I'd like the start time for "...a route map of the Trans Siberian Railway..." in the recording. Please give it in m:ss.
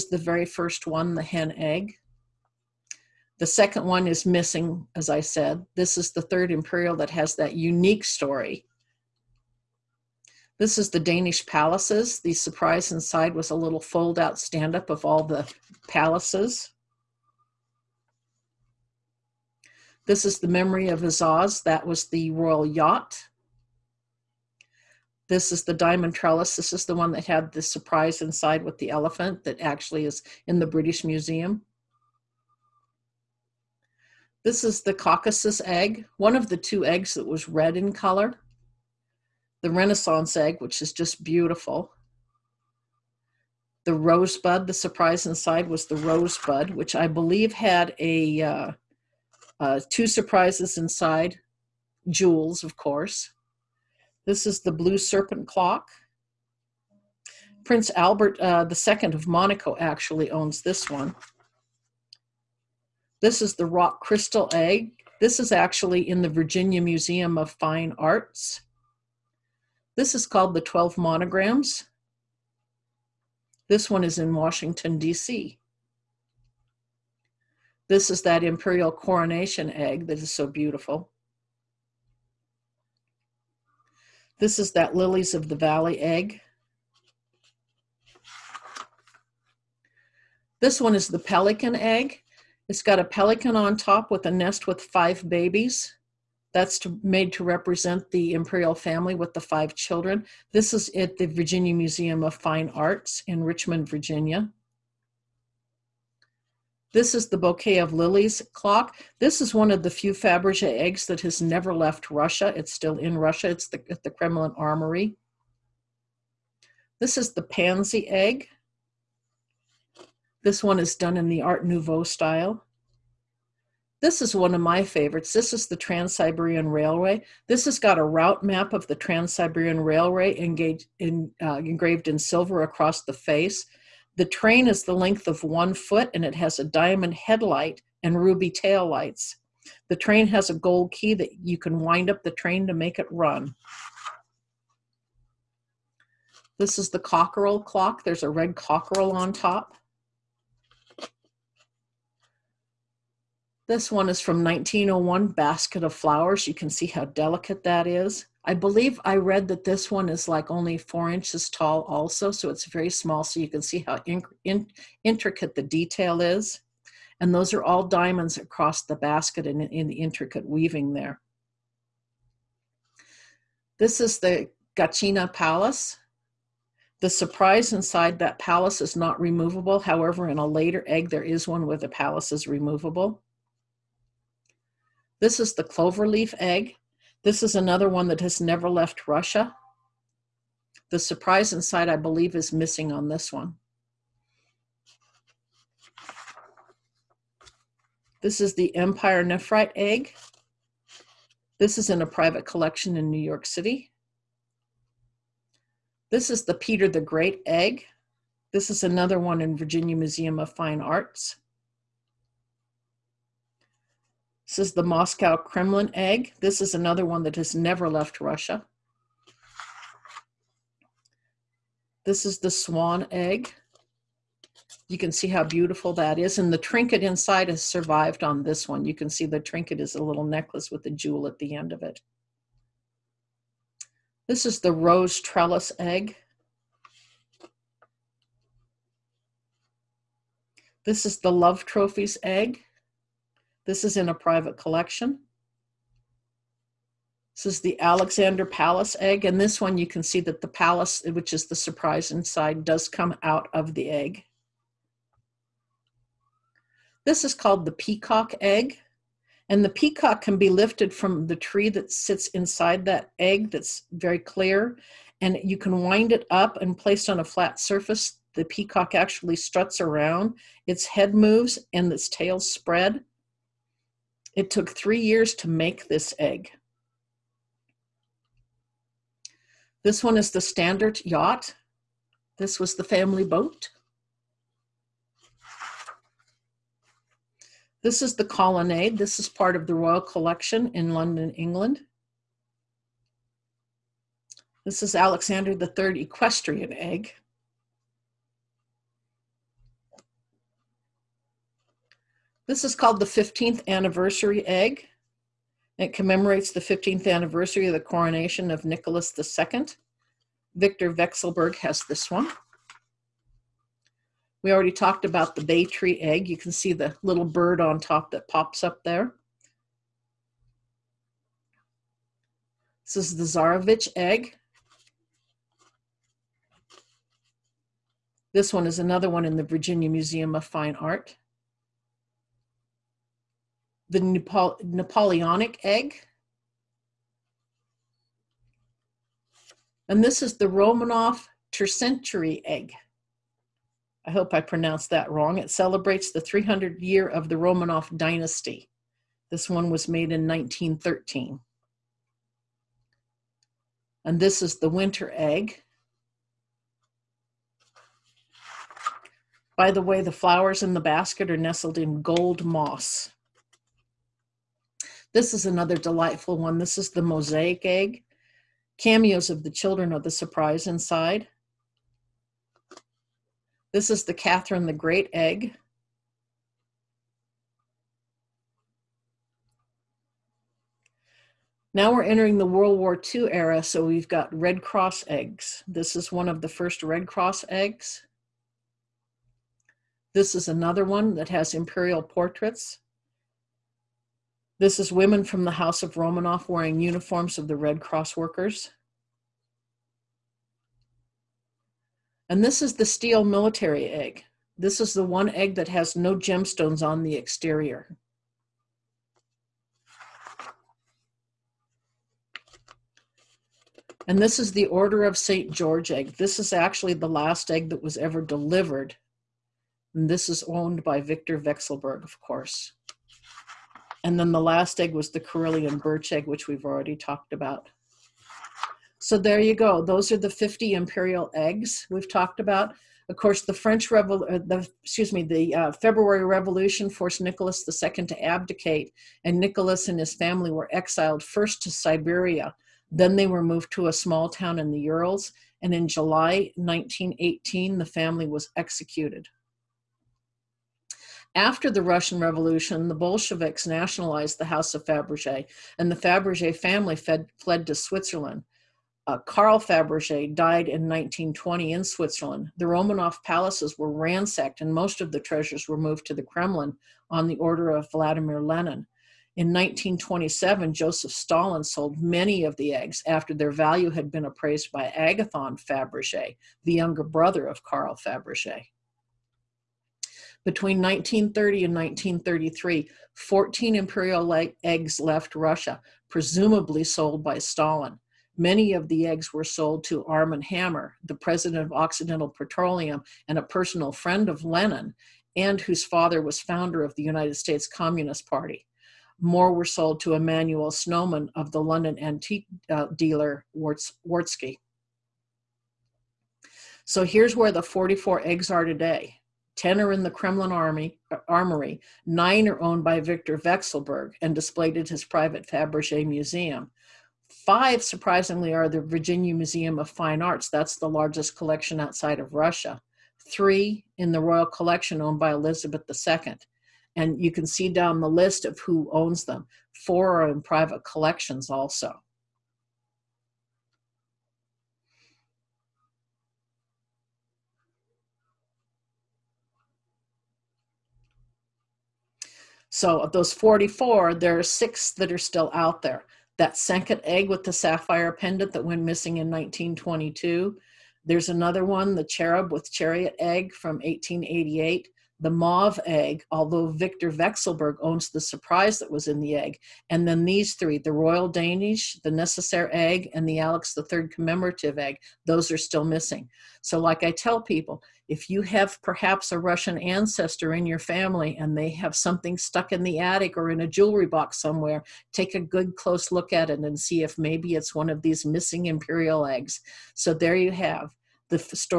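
2:07.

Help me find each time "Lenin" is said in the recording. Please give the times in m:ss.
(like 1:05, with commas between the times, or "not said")
7:48, 8:14.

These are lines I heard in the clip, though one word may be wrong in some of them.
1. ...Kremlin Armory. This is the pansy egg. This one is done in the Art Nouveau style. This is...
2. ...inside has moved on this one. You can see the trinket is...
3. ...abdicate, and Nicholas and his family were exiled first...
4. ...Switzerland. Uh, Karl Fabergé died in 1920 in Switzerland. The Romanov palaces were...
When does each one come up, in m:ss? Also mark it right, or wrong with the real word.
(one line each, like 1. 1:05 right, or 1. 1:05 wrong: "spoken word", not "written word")
1. 1:54 right
2. 3:47 wrong: "survived", not "moved"
3. 7:18 right
4. 7:37 right.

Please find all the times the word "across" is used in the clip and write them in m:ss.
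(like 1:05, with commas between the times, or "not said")
2:12, 2:48.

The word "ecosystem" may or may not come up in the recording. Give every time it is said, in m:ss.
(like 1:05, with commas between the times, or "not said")
not said.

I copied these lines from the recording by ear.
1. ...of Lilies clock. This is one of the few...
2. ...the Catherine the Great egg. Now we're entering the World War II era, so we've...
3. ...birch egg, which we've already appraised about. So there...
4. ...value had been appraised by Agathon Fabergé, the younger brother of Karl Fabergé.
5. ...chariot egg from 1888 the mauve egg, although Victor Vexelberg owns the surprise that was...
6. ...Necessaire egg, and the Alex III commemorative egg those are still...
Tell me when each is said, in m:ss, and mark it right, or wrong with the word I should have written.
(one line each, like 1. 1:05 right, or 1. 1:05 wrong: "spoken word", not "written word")
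1. 1:47 right
2. 6:14 right
3. 7:05 wrong: "talked", not "appraised"
4. 7:53 right
5. 9:12 right
6. 9:22 right.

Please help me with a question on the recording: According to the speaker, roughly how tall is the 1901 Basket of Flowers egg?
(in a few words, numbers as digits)
4 inches.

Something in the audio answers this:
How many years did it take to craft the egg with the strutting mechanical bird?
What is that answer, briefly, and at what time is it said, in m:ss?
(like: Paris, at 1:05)
3 years, at 4:34.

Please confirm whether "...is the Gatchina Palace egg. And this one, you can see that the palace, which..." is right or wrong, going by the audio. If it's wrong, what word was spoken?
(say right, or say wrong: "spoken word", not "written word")
wrong: "Alexander", not "Gatchina".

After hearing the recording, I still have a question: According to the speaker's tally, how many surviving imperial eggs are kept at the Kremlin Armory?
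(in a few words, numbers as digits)
10.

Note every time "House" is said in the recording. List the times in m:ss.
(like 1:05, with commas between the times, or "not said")
6:35, 7:34.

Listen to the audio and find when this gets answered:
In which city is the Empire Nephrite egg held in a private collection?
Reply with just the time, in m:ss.
3:23.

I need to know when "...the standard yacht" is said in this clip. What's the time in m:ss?
4:40.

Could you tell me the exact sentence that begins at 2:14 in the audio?
The train is the length of one foot and it has a diamond headlight and ruby tail lights.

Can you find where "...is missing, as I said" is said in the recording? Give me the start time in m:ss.
0:04.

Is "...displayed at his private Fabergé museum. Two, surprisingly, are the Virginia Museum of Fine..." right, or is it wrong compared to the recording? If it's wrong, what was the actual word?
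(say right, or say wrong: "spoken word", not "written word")
wrong: "Five", not "Two".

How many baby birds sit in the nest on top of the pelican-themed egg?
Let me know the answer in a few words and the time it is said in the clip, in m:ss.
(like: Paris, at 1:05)
5, at 1:34.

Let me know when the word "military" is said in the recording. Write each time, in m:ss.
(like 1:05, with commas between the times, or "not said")
6:43.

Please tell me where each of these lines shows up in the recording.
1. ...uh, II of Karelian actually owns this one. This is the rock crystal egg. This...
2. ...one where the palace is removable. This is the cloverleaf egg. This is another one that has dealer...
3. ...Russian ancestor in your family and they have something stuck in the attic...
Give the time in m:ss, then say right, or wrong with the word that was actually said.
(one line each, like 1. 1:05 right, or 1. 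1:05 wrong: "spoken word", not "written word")
1. 0:58 wrong: "Monaco", not "Karelian"
2. 3:01 wrong: "never", not "dealer"
3. 9:29 right.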